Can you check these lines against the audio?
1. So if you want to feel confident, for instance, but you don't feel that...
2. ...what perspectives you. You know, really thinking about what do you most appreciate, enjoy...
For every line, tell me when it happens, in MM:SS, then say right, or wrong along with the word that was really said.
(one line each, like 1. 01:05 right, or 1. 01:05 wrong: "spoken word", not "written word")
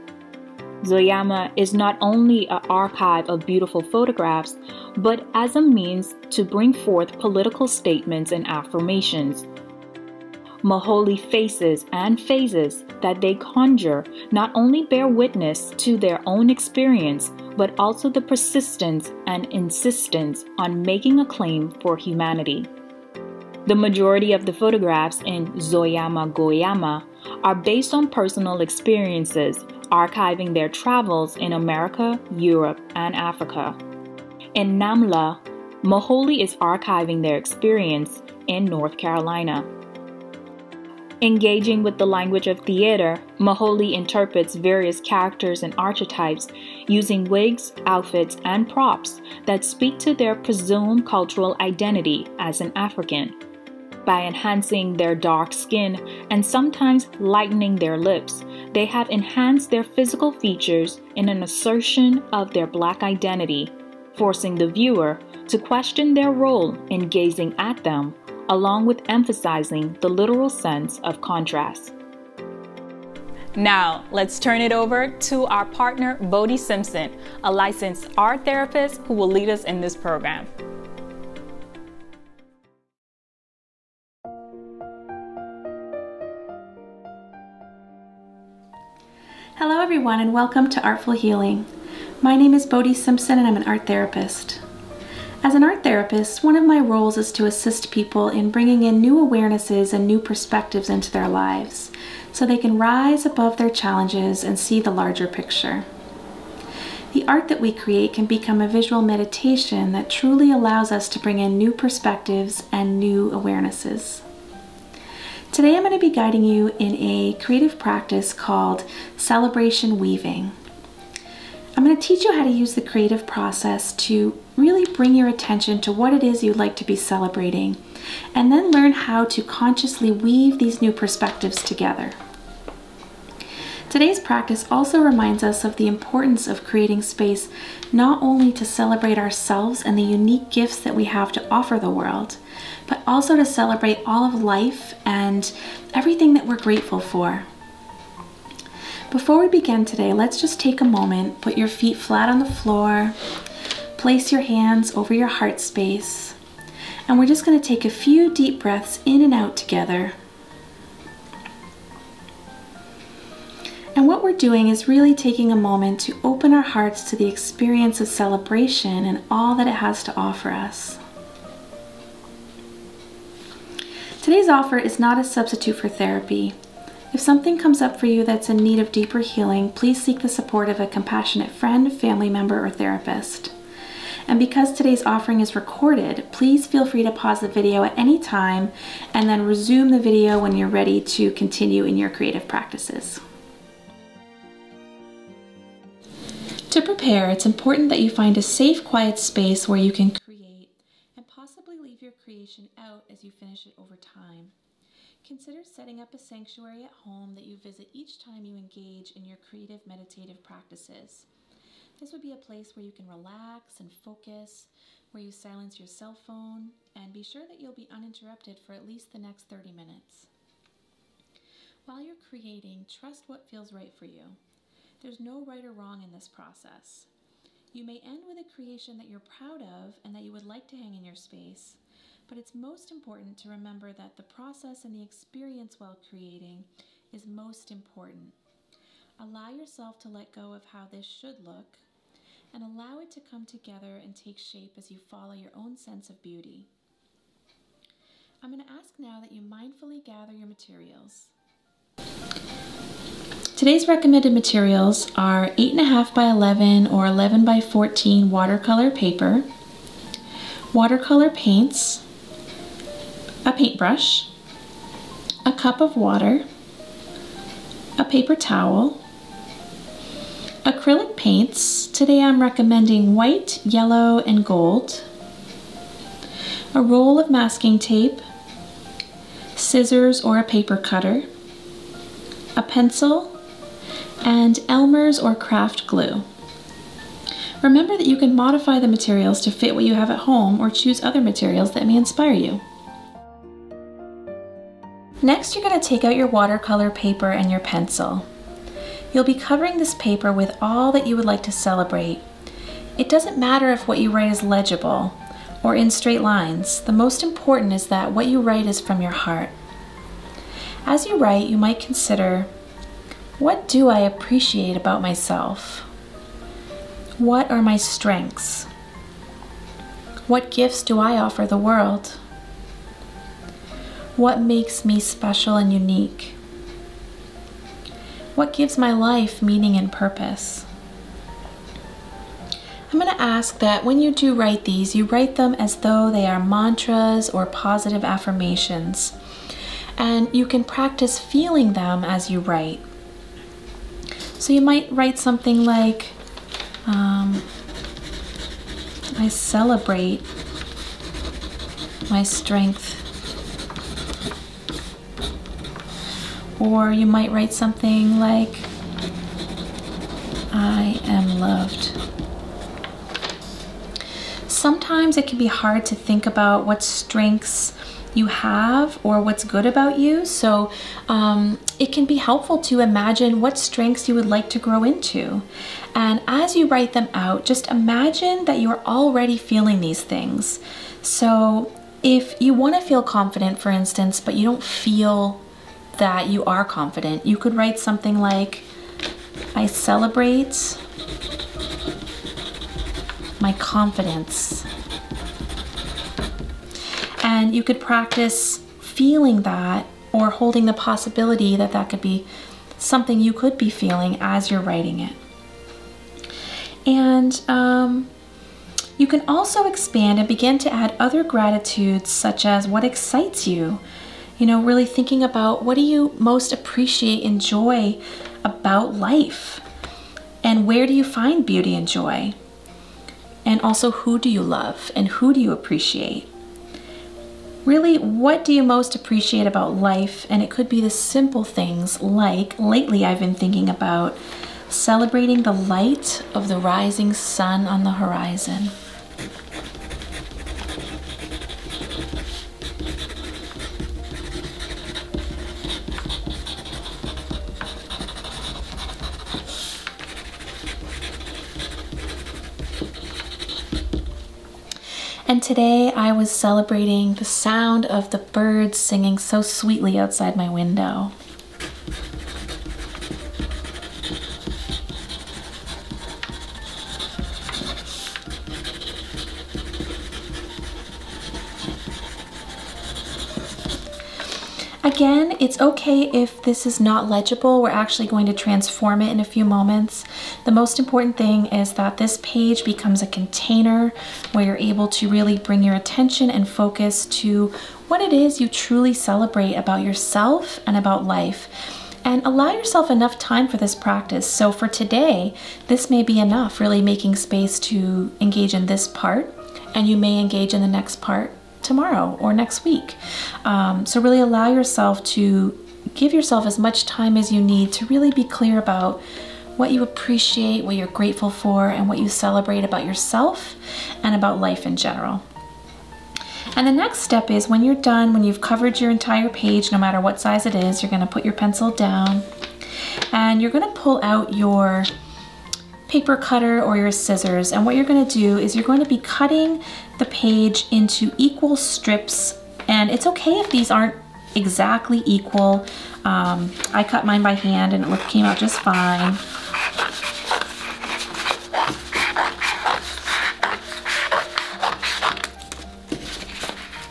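1. 06:21 right
2. 06:52 wrong: "excites", not "perspectives".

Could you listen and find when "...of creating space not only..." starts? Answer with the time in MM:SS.
02:16.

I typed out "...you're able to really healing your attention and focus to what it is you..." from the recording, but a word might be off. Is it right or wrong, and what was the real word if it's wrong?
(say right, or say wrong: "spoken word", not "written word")
wrong: "bring", not "healing".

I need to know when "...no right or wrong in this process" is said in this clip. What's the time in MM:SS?
03:45.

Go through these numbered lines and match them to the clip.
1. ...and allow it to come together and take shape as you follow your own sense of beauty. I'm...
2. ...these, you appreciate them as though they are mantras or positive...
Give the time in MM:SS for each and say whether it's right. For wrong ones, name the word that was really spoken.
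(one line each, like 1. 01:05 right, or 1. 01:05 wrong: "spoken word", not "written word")
1. 04:02 right
2. 05:34 wrong: "write", not "appreciate".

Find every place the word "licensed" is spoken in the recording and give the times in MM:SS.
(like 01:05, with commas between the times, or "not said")
01:17.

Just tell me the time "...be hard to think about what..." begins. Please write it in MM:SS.
06:05.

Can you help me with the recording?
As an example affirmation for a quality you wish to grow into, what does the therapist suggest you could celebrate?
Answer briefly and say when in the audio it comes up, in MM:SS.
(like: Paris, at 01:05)
my confidence, at 06:33.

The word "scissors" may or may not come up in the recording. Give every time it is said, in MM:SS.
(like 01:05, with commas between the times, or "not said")
04:39, 08:46.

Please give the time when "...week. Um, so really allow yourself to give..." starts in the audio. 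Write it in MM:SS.
08:22.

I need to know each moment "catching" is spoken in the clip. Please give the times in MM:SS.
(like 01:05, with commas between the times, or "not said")
not said.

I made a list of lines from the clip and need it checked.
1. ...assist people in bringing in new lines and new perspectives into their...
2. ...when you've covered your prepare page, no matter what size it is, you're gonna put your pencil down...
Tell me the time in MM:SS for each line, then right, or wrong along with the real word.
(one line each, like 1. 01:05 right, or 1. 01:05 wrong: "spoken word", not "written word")
1. 01:37 wrong: "awarenesses", not "lines"
2. 08:38 wrong: "entire", not "prepare".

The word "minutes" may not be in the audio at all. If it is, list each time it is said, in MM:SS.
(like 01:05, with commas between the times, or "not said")
03:39.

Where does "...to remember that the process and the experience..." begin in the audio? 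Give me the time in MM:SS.
03:53.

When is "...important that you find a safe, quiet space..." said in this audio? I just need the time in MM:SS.
03:17.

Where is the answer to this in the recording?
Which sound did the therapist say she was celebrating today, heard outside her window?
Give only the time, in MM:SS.
07:38.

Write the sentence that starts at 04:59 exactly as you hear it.
You'll be covering this paper with all that you would like to celebrate.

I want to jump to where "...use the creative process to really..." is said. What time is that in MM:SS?
02:02.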